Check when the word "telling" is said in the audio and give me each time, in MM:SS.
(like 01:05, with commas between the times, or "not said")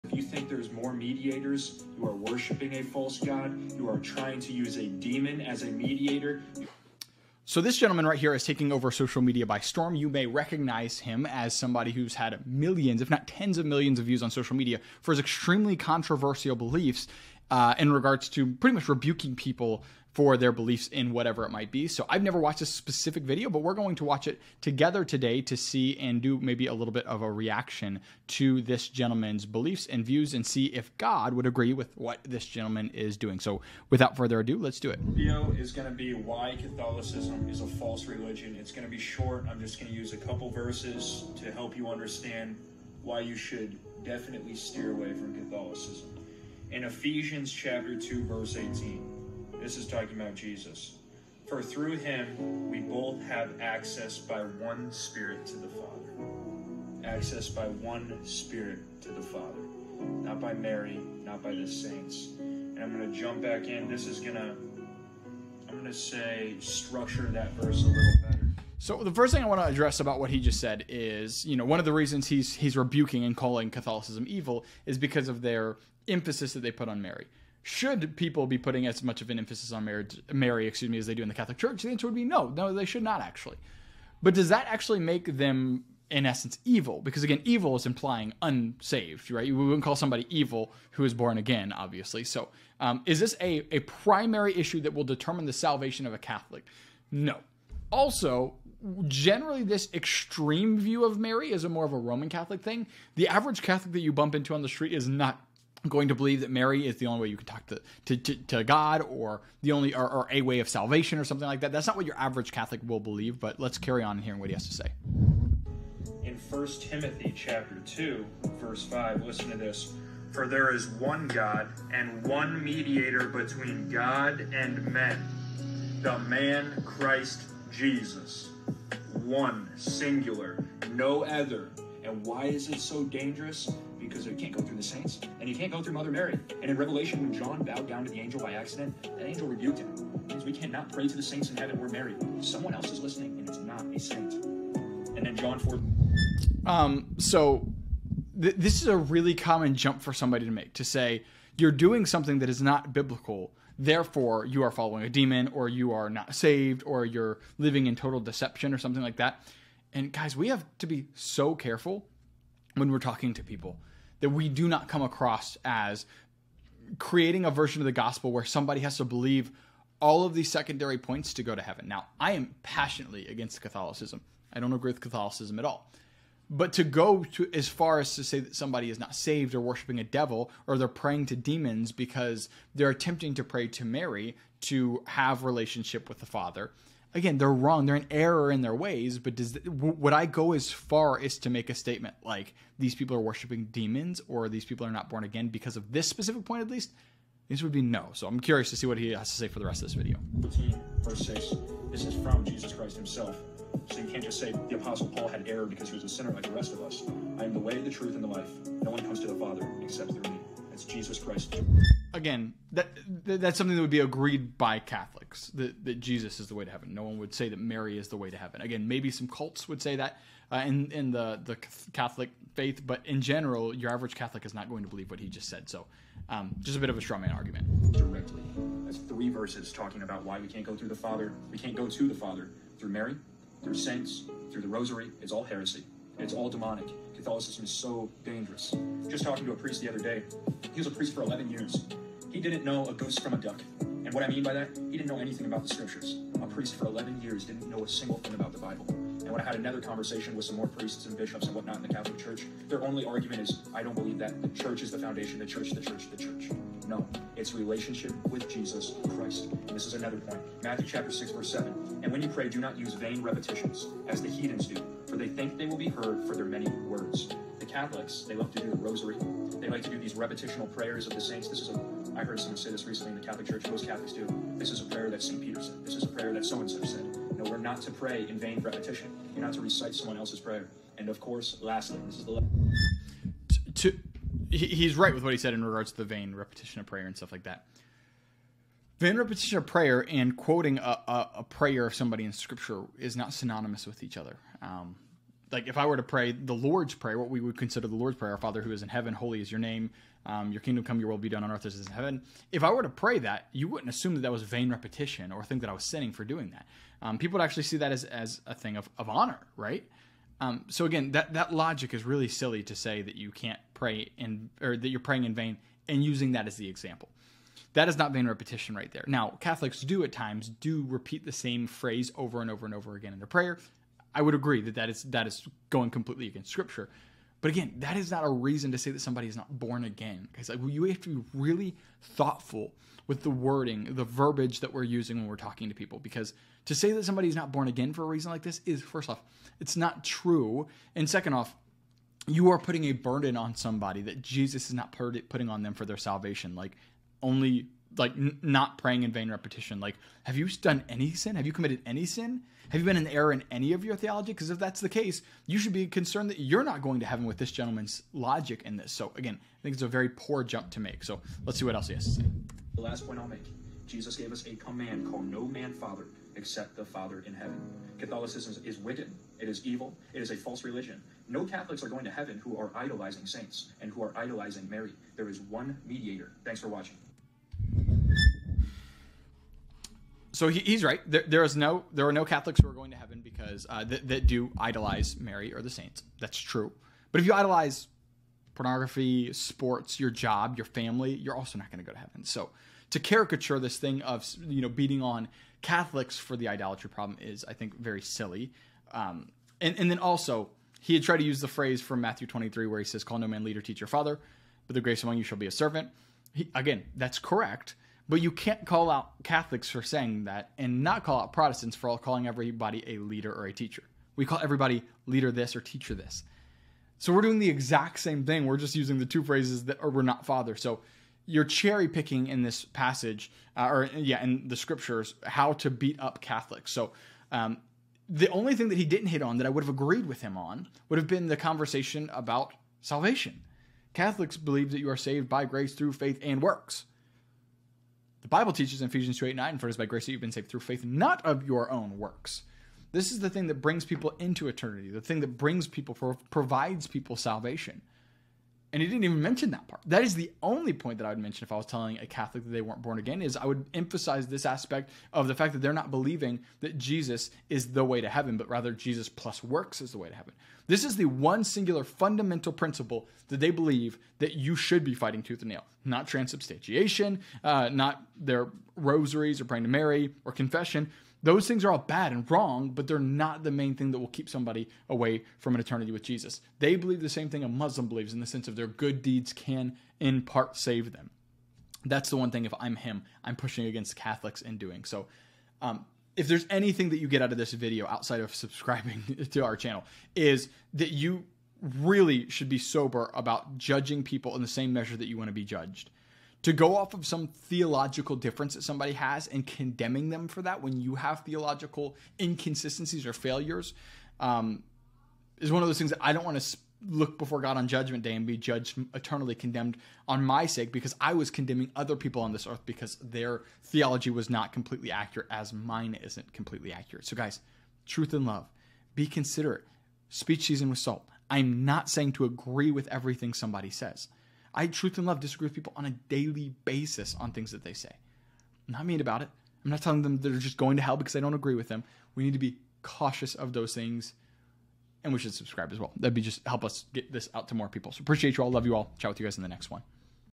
07:31, 08:49.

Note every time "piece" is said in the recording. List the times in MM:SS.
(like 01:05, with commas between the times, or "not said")
not said.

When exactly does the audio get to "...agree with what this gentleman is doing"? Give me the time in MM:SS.
00:31.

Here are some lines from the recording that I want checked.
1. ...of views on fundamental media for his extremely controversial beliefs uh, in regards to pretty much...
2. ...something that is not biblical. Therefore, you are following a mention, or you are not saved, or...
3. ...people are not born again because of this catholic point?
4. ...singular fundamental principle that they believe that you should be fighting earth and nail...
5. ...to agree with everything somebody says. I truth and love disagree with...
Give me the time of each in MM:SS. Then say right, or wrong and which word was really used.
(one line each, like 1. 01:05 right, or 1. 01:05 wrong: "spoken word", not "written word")
1. 00:13 wrong: "social", not "fundamental"
2. 02:32 wrong: "demon", not "mention"
3. 03:14 wrong: "specific", not "catholic"
4. 07:41 wrong: "tooth", not "earth"
5. 08:42 right.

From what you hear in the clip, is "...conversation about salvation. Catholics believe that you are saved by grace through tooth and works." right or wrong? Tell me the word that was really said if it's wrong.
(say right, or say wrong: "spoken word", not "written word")
wrong: "faith", not "tooth".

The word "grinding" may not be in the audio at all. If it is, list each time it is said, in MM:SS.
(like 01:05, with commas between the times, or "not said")
not said.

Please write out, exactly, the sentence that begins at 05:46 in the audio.
Like only like n- not praying in vain repetition.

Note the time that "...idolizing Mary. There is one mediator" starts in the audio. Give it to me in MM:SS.
06:14.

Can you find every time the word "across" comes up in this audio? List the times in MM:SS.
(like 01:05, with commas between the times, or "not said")
02:45.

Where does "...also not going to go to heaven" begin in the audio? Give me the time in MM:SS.
06:31.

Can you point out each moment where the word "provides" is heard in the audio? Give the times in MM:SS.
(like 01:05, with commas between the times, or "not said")
07:26.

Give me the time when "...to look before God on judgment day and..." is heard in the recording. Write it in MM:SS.
08:26.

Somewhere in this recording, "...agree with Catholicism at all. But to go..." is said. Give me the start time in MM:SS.
02:54.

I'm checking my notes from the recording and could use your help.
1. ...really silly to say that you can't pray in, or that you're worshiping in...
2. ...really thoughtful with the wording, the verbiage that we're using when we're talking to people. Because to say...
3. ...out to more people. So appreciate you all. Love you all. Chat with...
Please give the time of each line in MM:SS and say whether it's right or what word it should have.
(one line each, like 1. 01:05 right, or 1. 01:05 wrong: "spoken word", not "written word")
1. 05:12 wrong: "praying", not "worshiping"
2. 05:31 right
3. 08:57 right.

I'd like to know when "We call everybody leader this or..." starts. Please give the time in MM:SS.
06:54.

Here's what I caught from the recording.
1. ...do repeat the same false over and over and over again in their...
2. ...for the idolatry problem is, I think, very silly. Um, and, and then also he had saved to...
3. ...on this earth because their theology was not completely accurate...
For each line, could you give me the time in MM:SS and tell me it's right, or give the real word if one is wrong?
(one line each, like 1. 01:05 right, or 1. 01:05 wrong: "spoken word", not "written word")
1. 05:20 wrong: "phrase", not "false"
2. 06:36 wrong: "tried", not "saved"
3. 08:32 right.